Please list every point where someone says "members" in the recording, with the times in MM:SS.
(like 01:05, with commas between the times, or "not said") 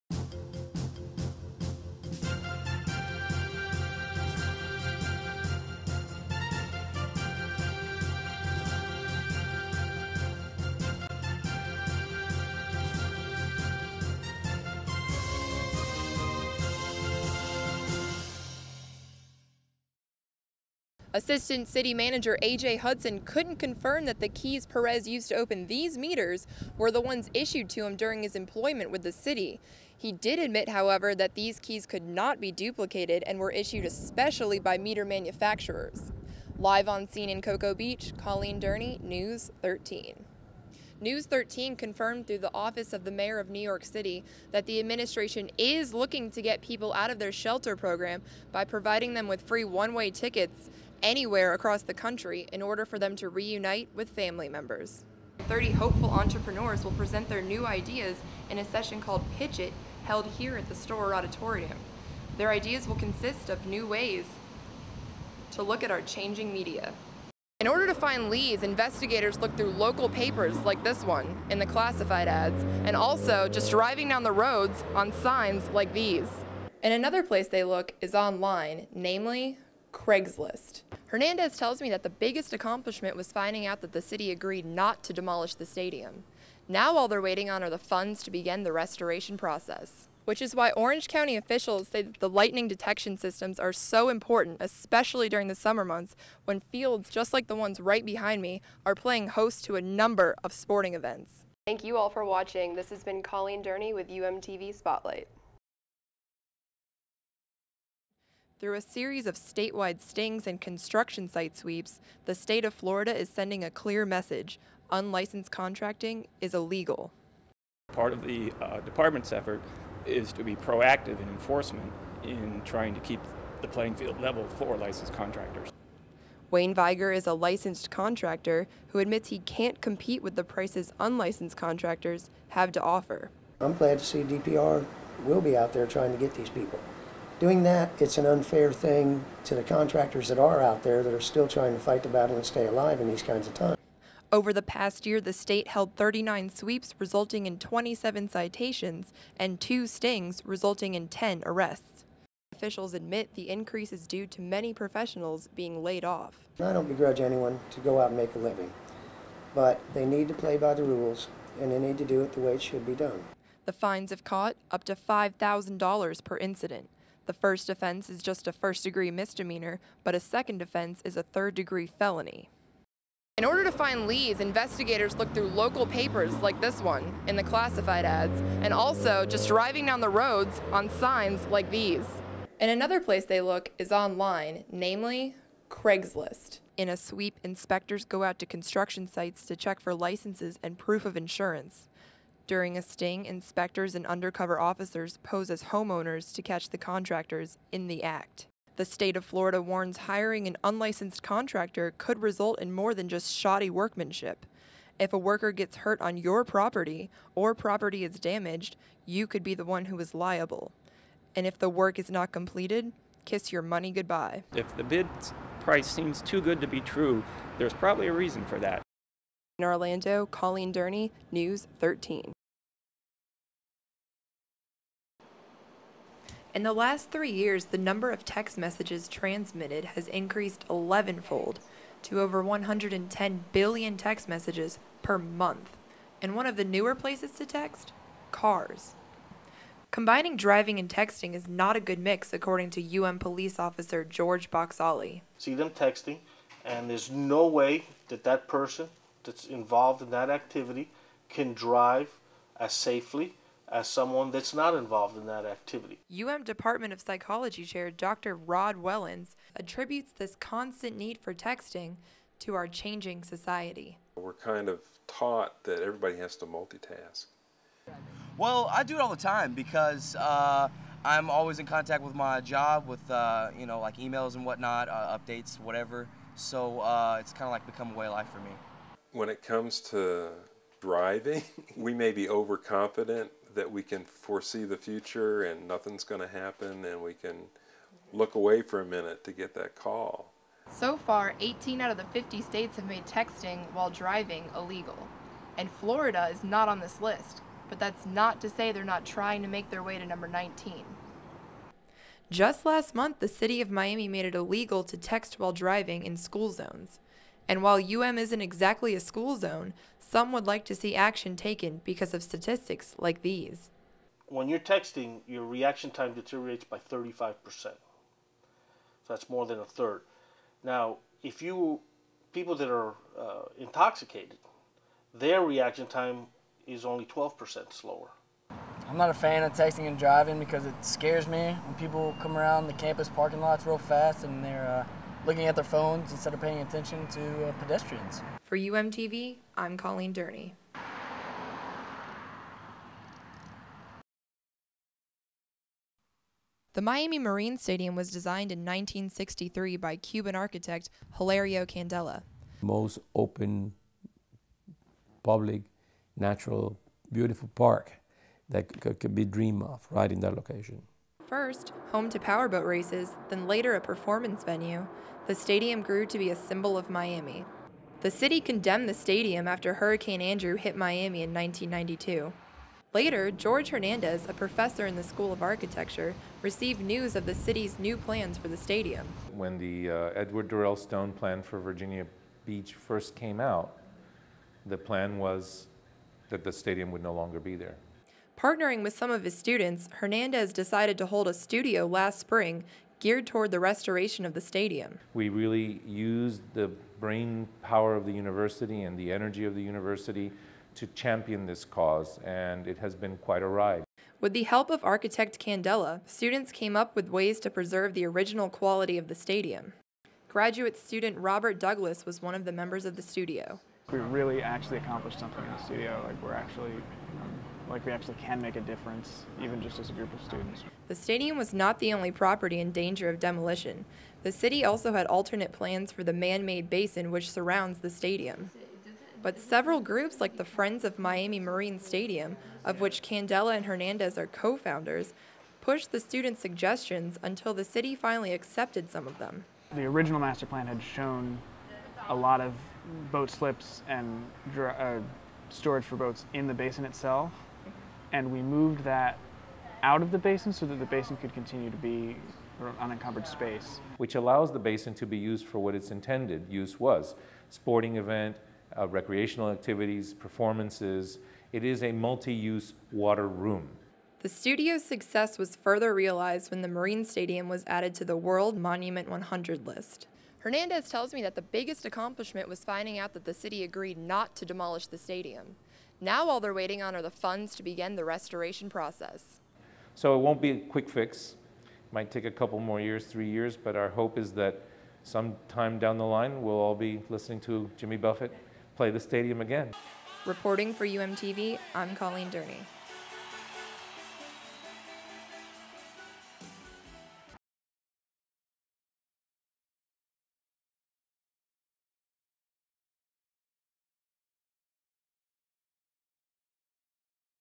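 00:54, 06:52.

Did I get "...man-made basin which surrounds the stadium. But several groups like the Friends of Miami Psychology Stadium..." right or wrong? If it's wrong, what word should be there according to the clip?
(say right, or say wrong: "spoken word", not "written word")
wrong: "Marine", not "Psychology".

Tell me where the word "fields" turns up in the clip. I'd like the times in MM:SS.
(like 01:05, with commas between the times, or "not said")
01:36, 02:03.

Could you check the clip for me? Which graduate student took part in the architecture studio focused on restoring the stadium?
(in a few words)
Robert Douglas.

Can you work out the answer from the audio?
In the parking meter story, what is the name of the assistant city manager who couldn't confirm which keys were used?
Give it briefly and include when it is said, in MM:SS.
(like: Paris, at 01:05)
A.J. Hudson, at 00:22.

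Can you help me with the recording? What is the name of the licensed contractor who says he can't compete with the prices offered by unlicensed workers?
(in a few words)
Wayne Viger.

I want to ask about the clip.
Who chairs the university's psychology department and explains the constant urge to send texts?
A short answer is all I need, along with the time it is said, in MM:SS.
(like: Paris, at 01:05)
Rod Wellens, at 04:18.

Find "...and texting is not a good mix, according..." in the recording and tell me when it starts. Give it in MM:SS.
04:00.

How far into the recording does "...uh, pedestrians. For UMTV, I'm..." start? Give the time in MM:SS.
05:37.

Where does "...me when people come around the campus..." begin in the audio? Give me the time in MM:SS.
05:31.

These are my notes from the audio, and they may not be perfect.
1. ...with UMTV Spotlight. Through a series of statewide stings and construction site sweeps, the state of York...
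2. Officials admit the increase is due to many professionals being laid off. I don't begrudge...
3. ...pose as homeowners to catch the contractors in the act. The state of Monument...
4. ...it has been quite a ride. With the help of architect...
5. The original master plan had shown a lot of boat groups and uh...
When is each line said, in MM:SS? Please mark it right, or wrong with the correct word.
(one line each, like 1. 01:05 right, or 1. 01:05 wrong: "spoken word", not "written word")
1. 01:43 wrong: "Florida", not "York"
2. 02:32 right
3. 03:15 wrong: "Florida", not "Monument"
4. 06:42 right
5. 07:19 wrong: "slips", not "groups".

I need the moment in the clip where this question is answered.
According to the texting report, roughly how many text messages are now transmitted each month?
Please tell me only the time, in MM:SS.
03:52.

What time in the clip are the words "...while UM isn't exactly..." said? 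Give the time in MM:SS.
05:07.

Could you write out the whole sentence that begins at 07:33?
Which allows the basin to be used for what its intended use was, sporting event, uh, recreational activities, performances.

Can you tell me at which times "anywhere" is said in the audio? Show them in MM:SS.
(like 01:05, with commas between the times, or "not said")
00:51.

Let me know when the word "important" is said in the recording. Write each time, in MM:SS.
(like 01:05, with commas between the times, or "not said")
01:34.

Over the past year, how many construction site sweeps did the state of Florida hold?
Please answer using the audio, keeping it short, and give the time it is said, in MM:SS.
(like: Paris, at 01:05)
39, at 02:25.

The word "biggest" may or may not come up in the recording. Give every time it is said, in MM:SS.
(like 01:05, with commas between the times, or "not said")
01:22, 07:51.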